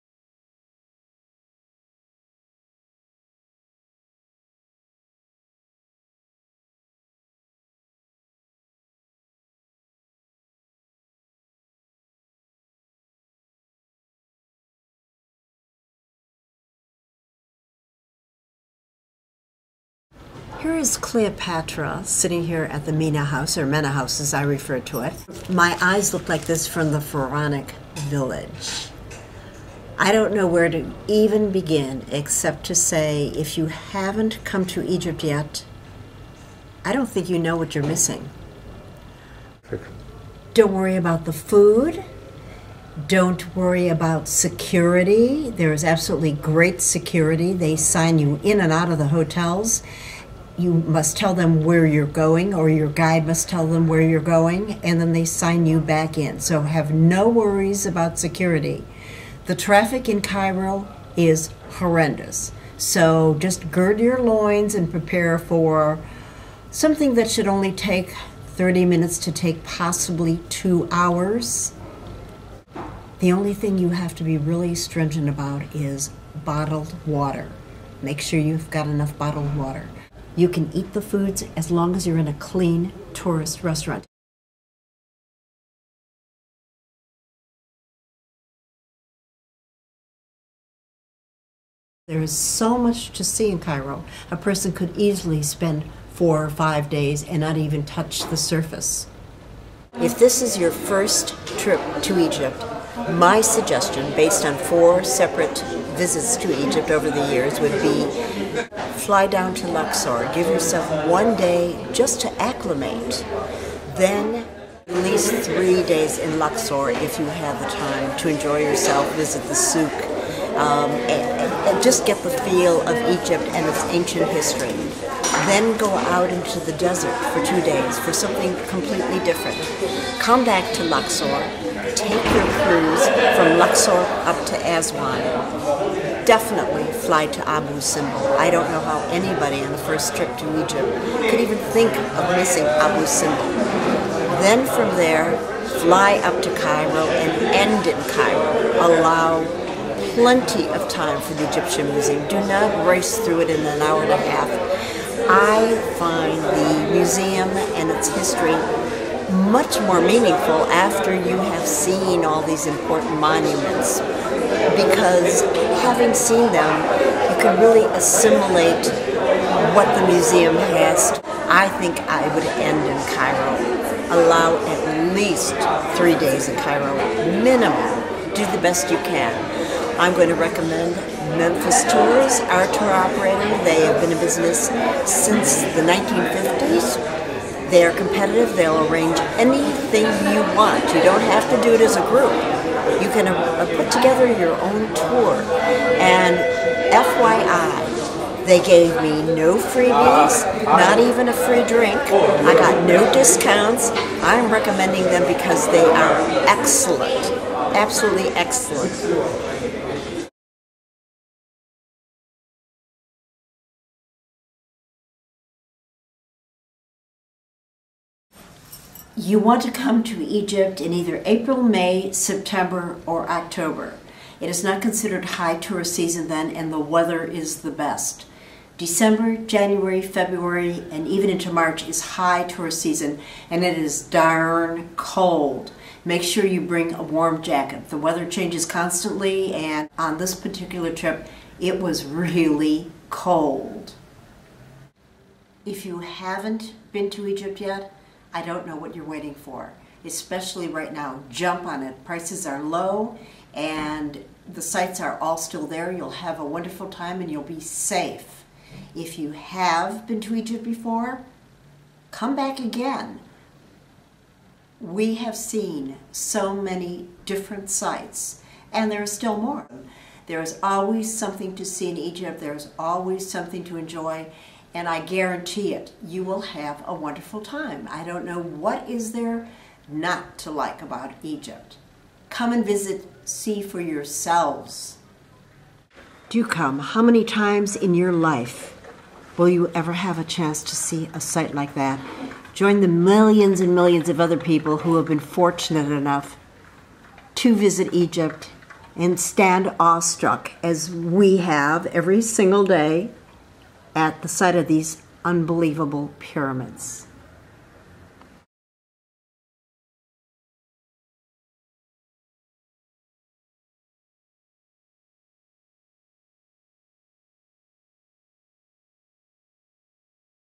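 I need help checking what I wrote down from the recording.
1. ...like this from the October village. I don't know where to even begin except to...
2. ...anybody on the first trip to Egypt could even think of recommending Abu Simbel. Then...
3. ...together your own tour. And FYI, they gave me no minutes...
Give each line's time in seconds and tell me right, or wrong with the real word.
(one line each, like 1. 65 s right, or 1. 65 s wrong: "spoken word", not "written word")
1. 26 s wrong: "Pharaonic", not "October"
2. 139 s wrong: "missing", not "recommending"
3. 193 s wrong: "freebies", not "minutes".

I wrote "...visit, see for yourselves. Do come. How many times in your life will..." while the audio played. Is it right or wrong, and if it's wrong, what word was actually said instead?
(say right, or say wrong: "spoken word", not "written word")
right.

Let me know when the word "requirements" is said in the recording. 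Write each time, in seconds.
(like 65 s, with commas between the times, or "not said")
not said.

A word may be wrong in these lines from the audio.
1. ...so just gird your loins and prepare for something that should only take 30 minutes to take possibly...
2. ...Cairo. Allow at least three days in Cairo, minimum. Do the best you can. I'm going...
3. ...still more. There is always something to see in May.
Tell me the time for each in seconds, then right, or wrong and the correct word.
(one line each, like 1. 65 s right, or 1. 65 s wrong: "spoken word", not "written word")
1. 62 s right
2. 173 s right
3. 269 s wrong: "Egypt", not "May".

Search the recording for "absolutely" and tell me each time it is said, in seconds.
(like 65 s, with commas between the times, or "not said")
45 s, 207 s.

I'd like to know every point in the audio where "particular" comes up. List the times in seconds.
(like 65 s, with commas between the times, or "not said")
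240 s.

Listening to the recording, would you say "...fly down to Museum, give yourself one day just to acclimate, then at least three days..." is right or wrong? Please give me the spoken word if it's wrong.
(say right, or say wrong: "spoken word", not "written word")
wrong: "Luxor", not "Museum".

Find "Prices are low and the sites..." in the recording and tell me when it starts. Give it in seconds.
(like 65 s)
252 s.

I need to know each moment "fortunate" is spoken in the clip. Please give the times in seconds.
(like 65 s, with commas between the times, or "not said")
295 s.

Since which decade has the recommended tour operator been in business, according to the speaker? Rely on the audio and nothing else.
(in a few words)
1950s.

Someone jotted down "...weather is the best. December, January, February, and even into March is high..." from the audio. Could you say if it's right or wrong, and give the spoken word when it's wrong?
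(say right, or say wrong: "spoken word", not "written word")
right.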